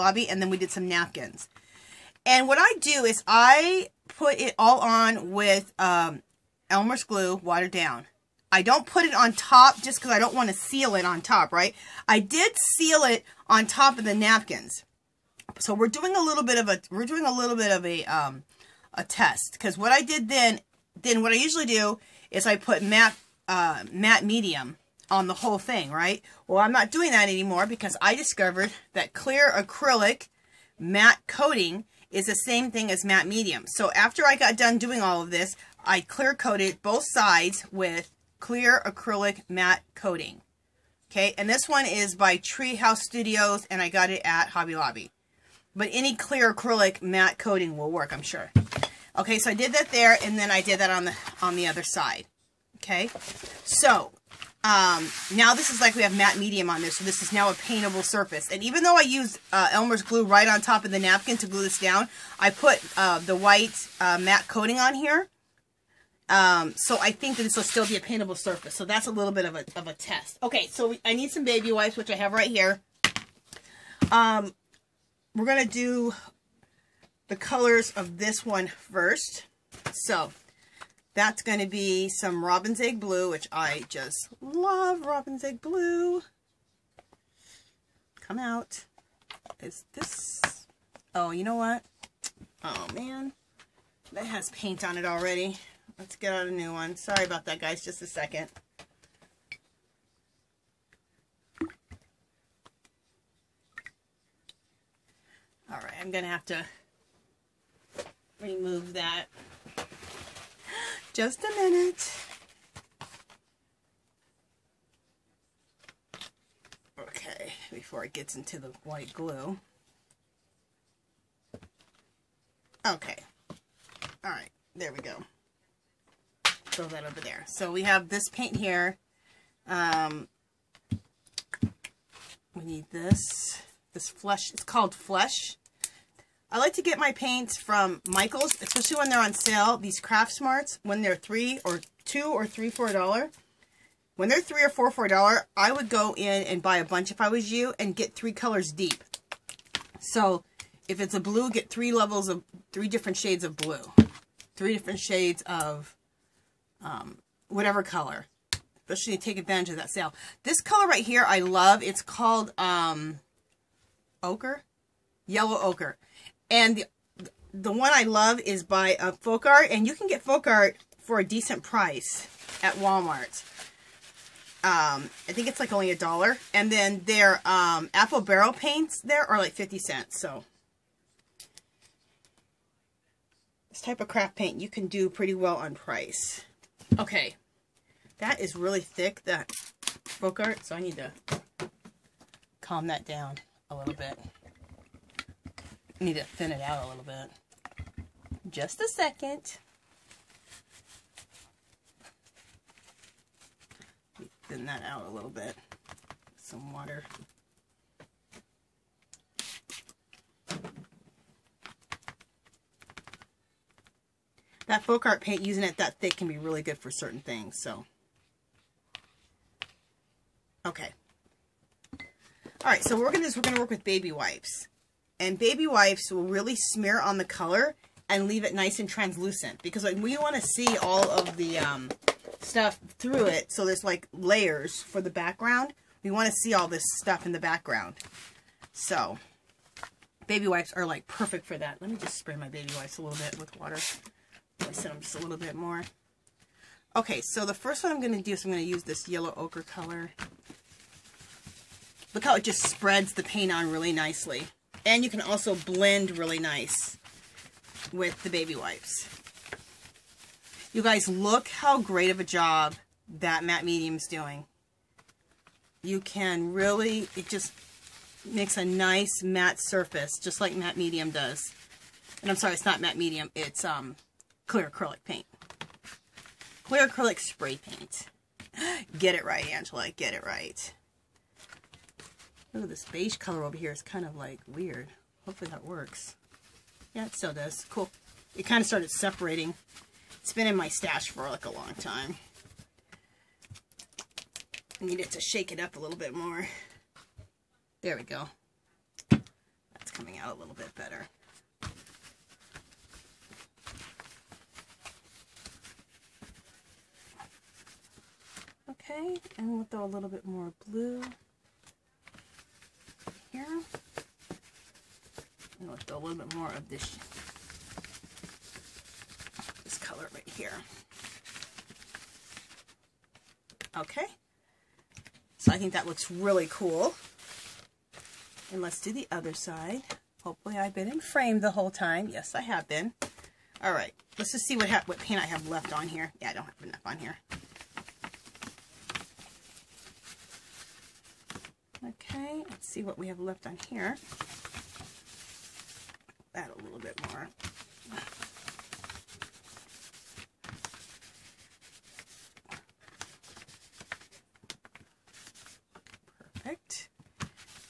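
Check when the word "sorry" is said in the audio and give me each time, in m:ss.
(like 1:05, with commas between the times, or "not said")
1:36, 4:32.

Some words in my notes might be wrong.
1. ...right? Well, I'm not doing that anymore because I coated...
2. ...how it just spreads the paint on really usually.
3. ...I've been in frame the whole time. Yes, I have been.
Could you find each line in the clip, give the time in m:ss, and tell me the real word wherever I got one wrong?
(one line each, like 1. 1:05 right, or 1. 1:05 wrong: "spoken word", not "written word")
1. 0:25 wrong: "discovered", not "coated"
2. 4:12 wrong: "nicely", not "usually"
3. 5:30 right.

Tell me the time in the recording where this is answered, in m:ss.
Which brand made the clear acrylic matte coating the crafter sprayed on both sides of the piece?
0:42.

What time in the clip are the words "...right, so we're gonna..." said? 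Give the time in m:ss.
3:42.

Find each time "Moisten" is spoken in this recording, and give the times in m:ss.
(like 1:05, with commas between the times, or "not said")
4:04.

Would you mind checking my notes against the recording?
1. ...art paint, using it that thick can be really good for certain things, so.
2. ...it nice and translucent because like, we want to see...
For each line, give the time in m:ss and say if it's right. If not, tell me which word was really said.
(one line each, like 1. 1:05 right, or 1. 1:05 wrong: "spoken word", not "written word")
1. 3:35 right
2. 3:48 right.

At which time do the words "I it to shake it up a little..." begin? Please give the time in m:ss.
4:54.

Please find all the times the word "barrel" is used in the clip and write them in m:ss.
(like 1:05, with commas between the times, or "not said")
2:58.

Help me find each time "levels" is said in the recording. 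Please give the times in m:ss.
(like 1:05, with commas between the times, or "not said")
2:31.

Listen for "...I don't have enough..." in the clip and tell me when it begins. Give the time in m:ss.
5:36.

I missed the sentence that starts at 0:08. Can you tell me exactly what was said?
I don't put it on top just because I don't want to seal it on top, right?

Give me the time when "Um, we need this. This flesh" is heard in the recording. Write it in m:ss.
2:09.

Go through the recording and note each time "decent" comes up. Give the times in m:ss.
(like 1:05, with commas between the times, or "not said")
2:51.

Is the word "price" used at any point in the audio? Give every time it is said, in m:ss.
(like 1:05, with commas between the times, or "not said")
2:51, 3:05.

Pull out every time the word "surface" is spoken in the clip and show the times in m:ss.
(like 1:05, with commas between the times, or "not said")
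0:58, 1:08, 4:29.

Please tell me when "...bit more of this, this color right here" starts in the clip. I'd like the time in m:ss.
5:16.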